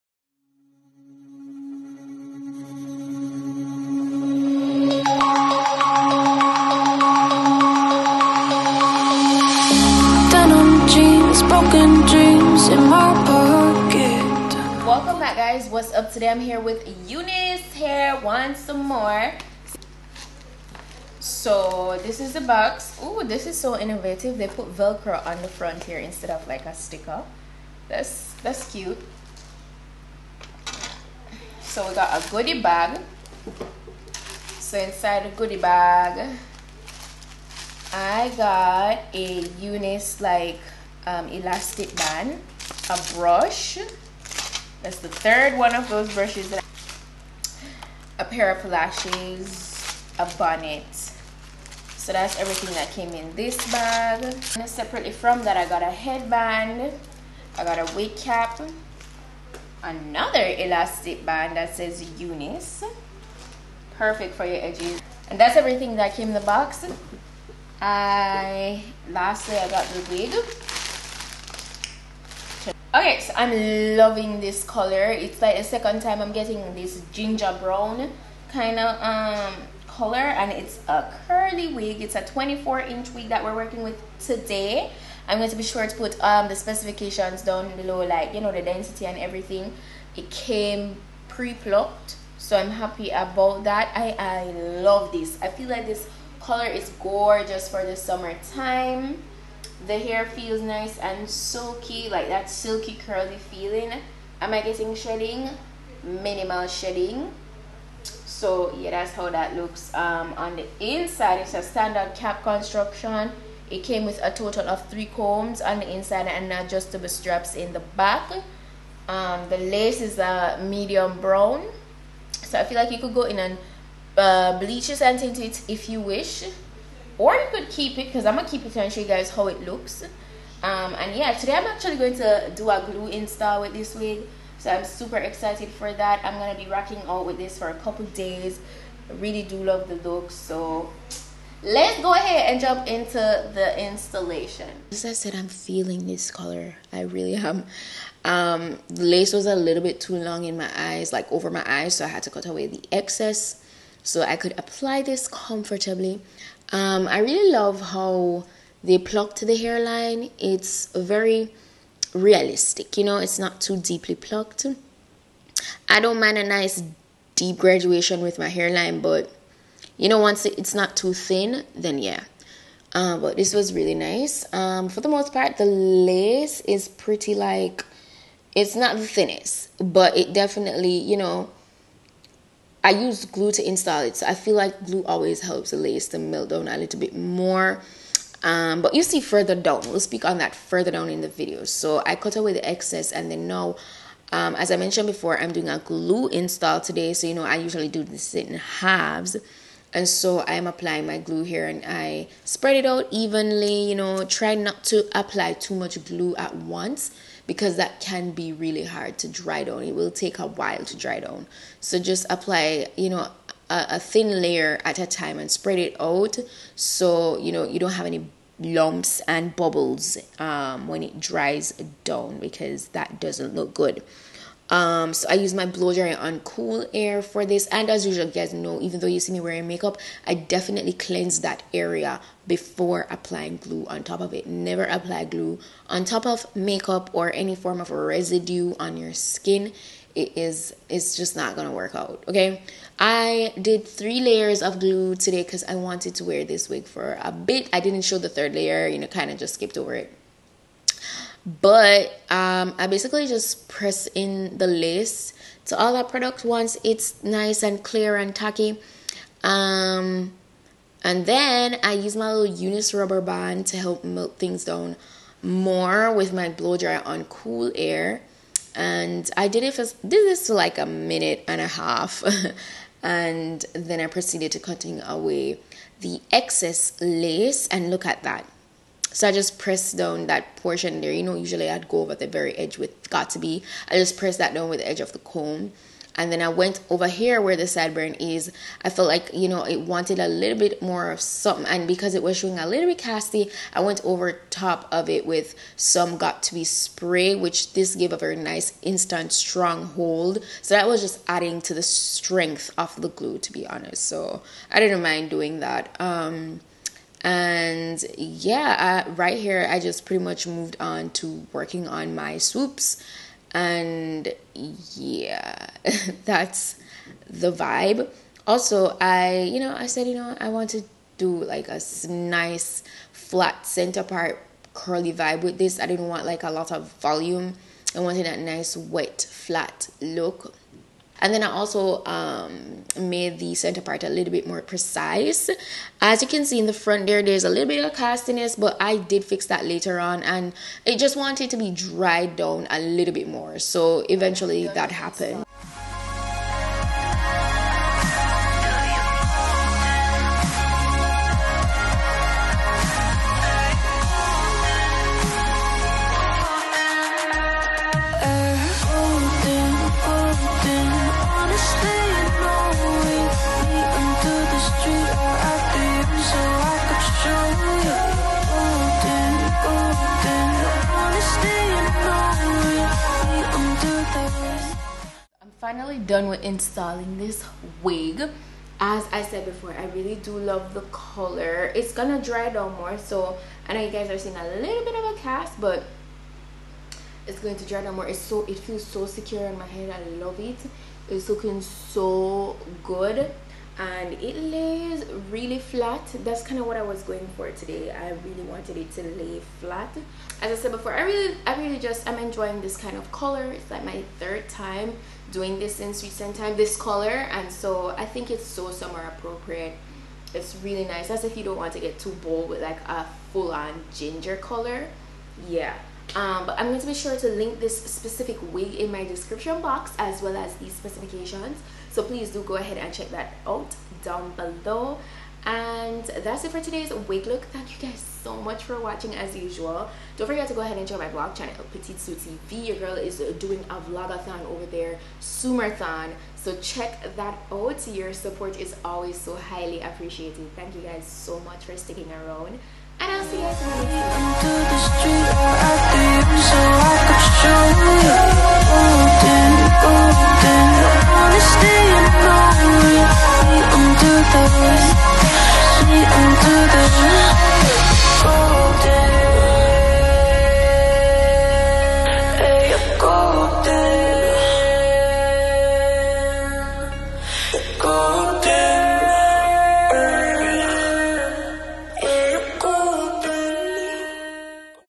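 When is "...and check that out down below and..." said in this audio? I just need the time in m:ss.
7:02.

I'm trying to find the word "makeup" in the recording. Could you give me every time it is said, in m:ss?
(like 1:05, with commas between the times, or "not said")
3:49, 3:56.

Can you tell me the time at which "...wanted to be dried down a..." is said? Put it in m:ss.
5:41.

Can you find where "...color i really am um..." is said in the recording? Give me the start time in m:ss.
2:26.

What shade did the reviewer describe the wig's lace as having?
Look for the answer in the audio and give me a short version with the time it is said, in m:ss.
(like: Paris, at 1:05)
Medium brown, at 2:00.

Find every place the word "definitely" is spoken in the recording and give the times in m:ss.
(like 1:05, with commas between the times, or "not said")
3:00, 3:50.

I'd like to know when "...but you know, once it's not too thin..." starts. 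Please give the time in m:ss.
2:49.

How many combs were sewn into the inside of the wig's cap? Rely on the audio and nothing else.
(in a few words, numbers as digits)
3.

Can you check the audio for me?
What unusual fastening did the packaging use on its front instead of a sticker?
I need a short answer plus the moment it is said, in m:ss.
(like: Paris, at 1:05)
Velcro, at 0:24.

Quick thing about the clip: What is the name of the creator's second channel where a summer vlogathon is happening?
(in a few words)
Petite Sue TV.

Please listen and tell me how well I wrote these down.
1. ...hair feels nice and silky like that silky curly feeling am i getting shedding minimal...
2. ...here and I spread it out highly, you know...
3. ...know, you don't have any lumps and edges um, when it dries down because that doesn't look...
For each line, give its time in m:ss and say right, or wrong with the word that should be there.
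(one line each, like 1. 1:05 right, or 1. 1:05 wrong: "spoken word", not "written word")
1. 1:39 right
2. 3:21 wrong: "evenly", not "highly"
3. 3:37 wrong: "bubbles", not "edges".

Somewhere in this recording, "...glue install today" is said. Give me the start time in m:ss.
3:15.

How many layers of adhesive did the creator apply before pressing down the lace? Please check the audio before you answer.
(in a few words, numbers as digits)
3.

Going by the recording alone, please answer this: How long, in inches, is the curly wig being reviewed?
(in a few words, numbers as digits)
24 inch.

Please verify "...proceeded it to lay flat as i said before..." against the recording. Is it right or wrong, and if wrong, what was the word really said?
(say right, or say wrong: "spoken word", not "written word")
wrong: "wanted", not "proceeded".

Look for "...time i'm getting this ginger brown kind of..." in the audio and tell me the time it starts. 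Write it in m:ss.
1:16.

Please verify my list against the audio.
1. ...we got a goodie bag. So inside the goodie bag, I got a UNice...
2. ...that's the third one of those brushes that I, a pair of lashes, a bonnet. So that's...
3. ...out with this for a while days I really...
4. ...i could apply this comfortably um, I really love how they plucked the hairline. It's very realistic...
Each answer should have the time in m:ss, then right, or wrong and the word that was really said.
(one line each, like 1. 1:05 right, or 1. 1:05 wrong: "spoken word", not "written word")
1. 0:31 right
2. 0:44 right
3. 2:17 wrong: "couple", not "while"
4. 2:34 right.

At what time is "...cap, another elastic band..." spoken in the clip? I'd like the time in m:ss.
0:58.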